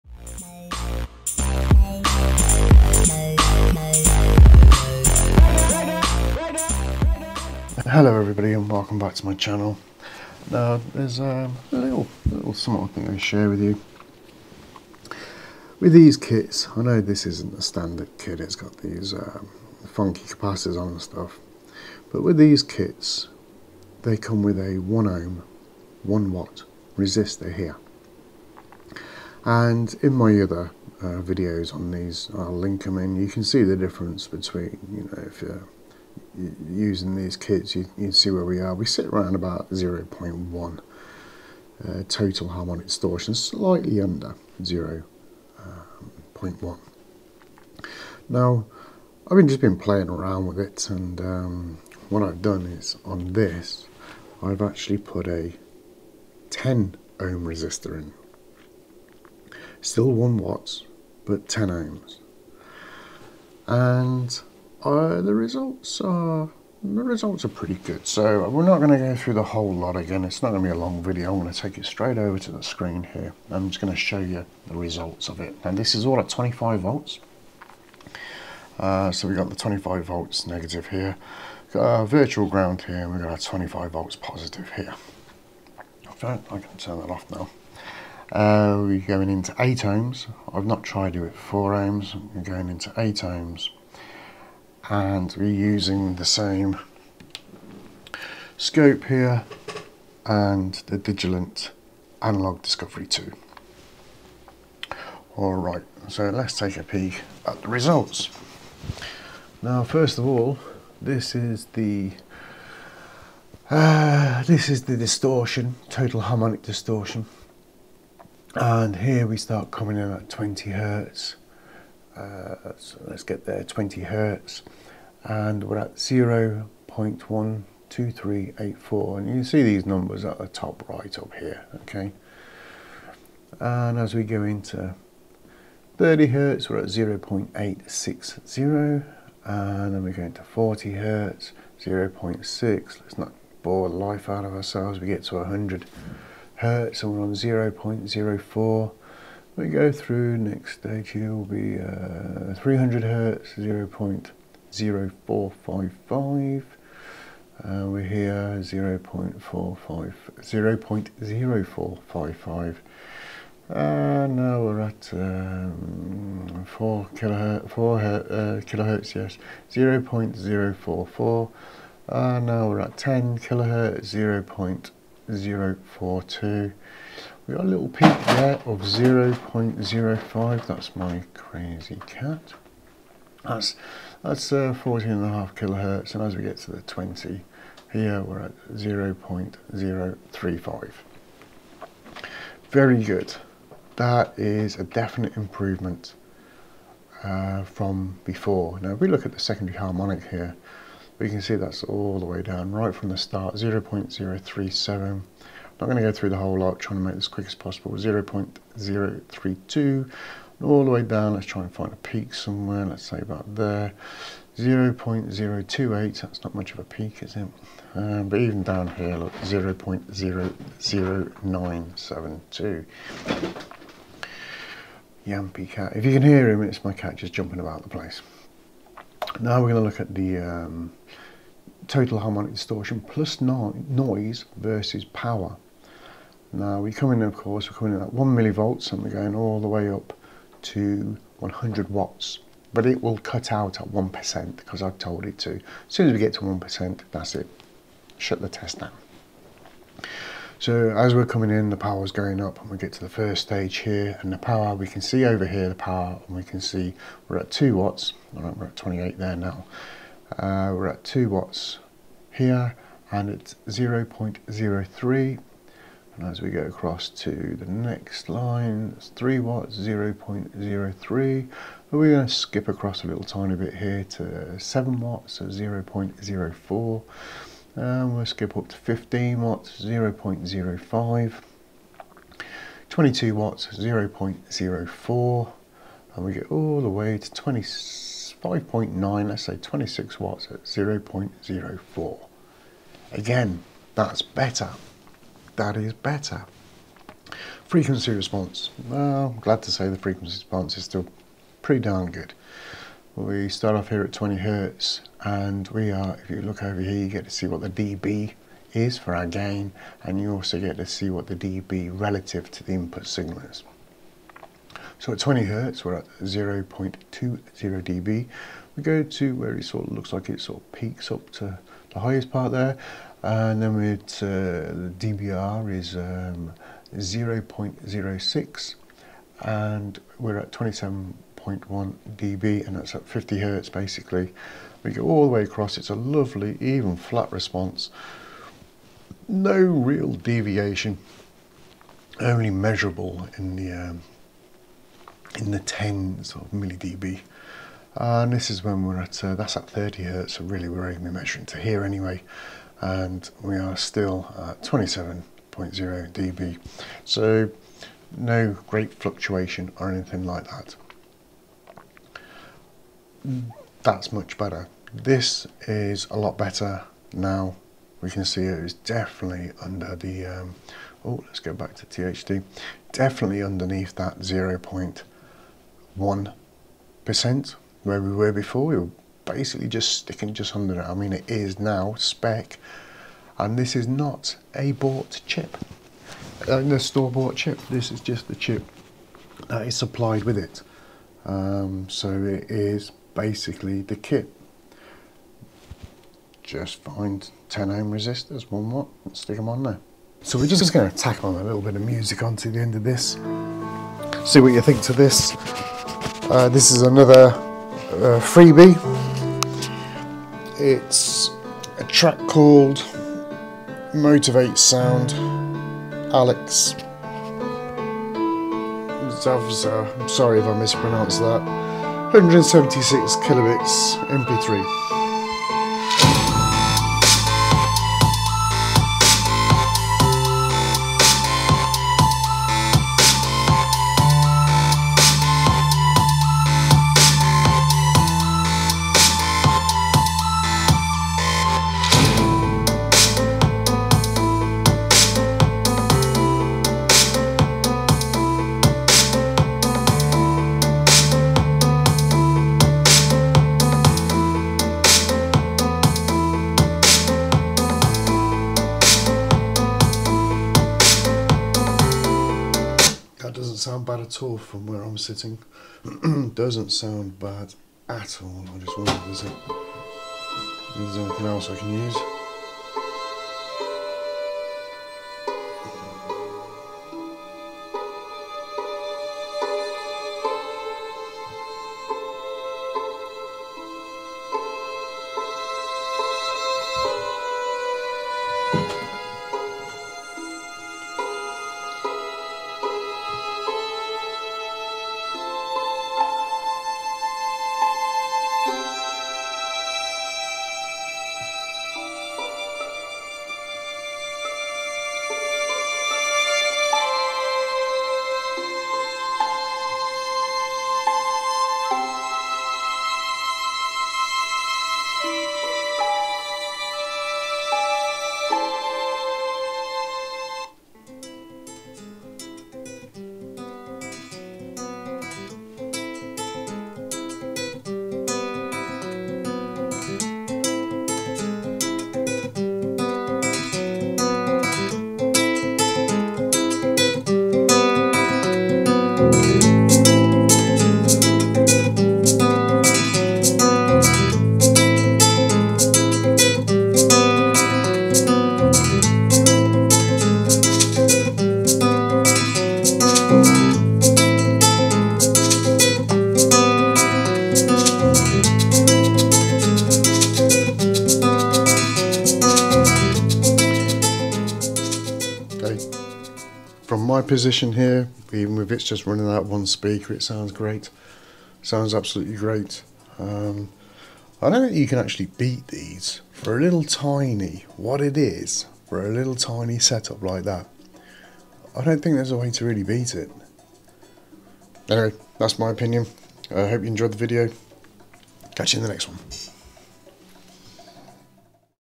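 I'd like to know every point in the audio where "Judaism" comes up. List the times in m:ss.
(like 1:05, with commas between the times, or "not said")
not said.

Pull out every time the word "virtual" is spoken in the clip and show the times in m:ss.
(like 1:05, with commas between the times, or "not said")
1:22.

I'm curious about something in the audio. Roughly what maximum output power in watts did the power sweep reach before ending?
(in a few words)
26 watts.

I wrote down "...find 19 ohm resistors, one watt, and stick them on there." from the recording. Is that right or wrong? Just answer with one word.
wrong.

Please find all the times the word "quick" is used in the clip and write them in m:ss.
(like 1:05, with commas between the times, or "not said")
3:27.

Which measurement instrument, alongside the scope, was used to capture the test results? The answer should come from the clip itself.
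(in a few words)
Digilent Analog Discovery 2.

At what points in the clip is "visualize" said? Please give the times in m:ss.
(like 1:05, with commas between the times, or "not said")
not said.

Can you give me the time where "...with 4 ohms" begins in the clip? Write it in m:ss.
1:31.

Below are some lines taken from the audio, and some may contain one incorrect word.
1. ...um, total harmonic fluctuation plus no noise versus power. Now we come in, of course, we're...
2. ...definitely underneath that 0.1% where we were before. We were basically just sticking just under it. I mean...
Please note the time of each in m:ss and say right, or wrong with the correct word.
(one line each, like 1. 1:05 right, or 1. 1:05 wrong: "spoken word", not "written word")
1. 3:50 wrong: "distortion", not "fluctuation"
2. 6:12 right.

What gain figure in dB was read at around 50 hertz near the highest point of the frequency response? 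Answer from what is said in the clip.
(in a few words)
27.1 dB.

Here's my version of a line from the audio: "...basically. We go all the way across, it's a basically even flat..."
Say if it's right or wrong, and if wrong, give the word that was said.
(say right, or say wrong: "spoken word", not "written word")
wrong: "lovely", not "basically".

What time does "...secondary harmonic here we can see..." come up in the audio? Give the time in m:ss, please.
3:19.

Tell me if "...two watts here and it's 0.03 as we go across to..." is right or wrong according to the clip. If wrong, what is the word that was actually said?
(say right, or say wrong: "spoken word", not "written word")
right.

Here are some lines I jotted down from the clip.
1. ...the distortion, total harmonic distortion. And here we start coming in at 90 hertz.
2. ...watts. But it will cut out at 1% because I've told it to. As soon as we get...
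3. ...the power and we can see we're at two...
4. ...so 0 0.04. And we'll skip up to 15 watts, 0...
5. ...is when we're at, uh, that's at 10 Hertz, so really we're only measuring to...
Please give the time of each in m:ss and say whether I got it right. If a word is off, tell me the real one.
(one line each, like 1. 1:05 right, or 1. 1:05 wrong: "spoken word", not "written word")
1. 1:54 wrong: "20", not "90"
2. 4:01 right
3. 4:15 right
4. 4:35 right
5. 5:48 wrong: "30", not "10".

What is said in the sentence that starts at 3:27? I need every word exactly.
0 0.032, all the way down.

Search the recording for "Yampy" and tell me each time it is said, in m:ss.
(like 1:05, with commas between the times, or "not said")
3:45.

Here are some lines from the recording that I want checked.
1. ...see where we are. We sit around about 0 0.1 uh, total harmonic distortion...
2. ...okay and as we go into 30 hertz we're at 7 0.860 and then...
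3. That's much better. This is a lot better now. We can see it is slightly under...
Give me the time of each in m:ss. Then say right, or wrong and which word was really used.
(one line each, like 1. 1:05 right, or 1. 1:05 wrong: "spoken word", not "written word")
1. 0:38 right
2. 2:11 wrong: "0", not "7"
3. 6:03 wrong: "definitely", not "slightly".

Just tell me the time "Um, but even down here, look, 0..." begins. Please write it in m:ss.
3:37.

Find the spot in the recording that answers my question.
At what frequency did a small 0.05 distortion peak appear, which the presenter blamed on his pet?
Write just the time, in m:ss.
3:04.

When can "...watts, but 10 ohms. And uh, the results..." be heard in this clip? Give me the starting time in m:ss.
1:00.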